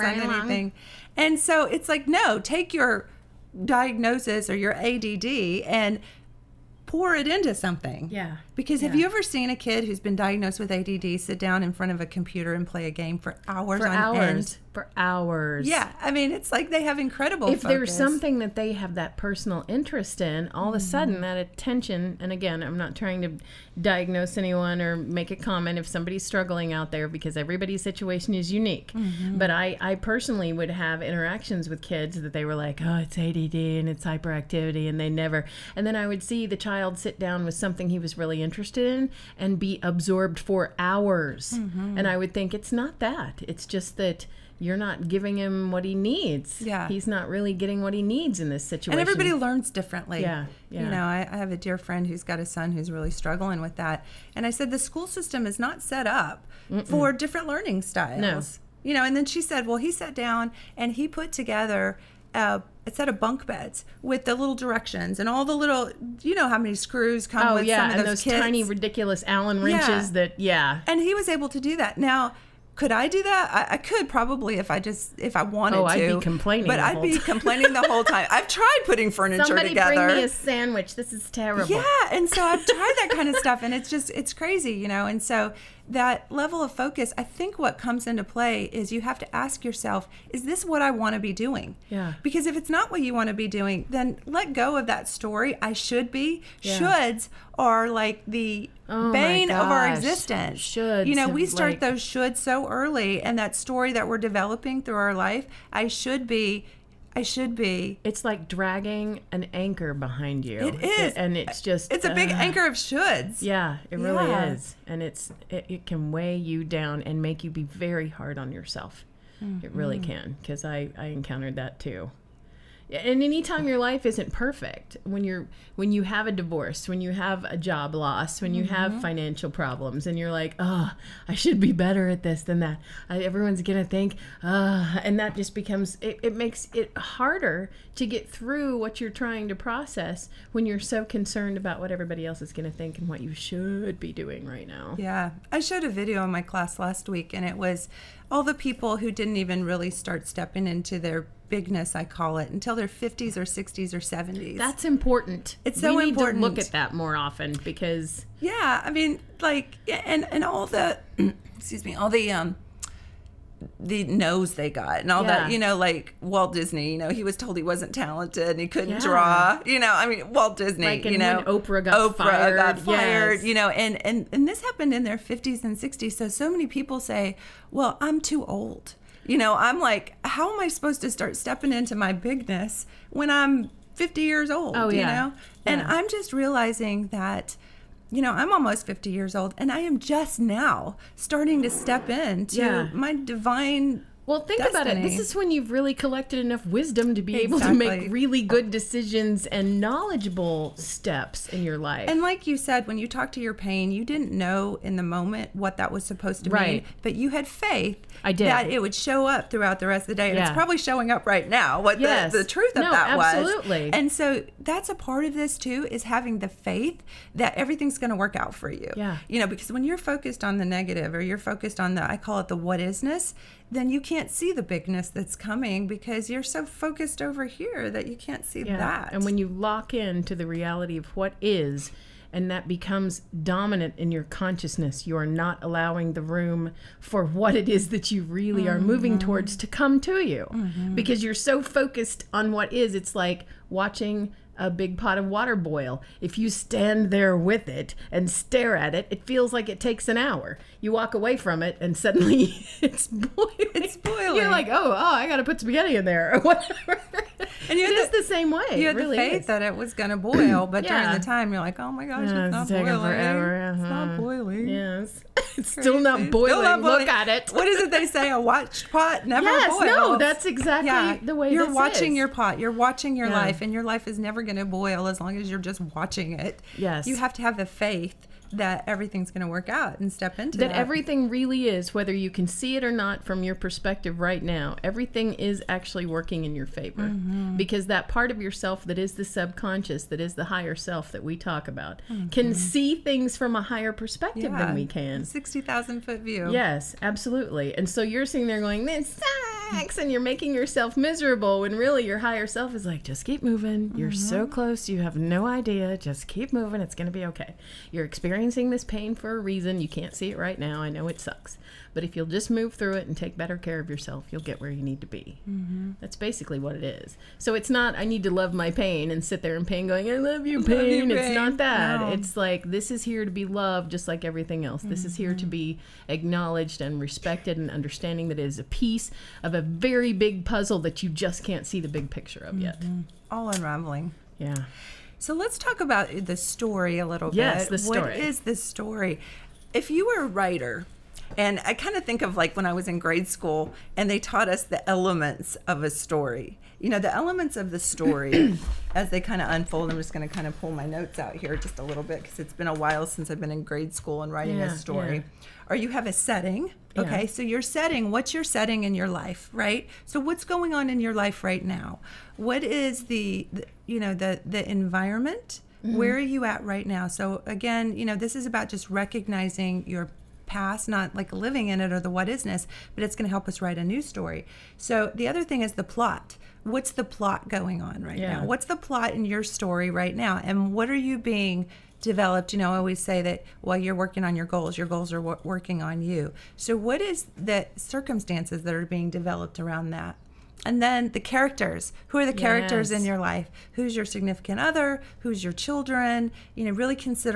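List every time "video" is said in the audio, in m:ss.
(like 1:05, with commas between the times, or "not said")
2:25.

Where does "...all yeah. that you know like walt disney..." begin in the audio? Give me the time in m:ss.
2:45.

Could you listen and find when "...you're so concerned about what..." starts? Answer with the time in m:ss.
2:20.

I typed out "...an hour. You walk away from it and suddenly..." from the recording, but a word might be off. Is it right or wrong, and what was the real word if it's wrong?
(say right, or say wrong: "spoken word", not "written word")
right.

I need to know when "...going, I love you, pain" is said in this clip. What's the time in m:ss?
5:19.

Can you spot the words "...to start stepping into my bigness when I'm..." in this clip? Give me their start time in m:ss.
3:01.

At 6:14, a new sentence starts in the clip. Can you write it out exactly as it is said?
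So the other thing is the plot.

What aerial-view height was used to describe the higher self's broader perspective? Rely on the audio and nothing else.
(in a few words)
60,000 feet.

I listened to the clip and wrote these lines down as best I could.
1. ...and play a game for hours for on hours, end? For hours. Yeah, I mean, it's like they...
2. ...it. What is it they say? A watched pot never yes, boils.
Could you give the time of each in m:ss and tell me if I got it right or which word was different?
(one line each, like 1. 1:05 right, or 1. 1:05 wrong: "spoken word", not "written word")
1. 0:12 right
2. 4:27 right.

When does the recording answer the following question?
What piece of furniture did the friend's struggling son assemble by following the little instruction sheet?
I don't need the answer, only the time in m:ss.
1:03.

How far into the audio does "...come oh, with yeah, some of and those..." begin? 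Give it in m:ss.
1:07.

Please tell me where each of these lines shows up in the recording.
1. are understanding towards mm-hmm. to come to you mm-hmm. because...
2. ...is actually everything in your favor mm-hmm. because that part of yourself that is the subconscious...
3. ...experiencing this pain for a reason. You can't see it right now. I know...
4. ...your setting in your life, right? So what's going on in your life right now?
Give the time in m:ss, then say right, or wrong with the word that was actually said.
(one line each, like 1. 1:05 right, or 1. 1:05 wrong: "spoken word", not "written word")
1. 3:58 wrong: "moving", not "understanding"
2. 4:45 wrong: "working", not "everything"
3. 5:08 right
4. 5:58 right.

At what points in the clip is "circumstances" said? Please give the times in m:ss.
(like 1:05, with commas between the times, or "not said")
6:27.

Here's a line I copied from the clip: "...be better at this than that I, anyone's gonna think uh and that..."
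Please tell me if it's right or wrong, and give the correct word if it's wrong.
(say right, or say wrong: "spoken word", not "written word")
wrong: "everyone", not "anyone".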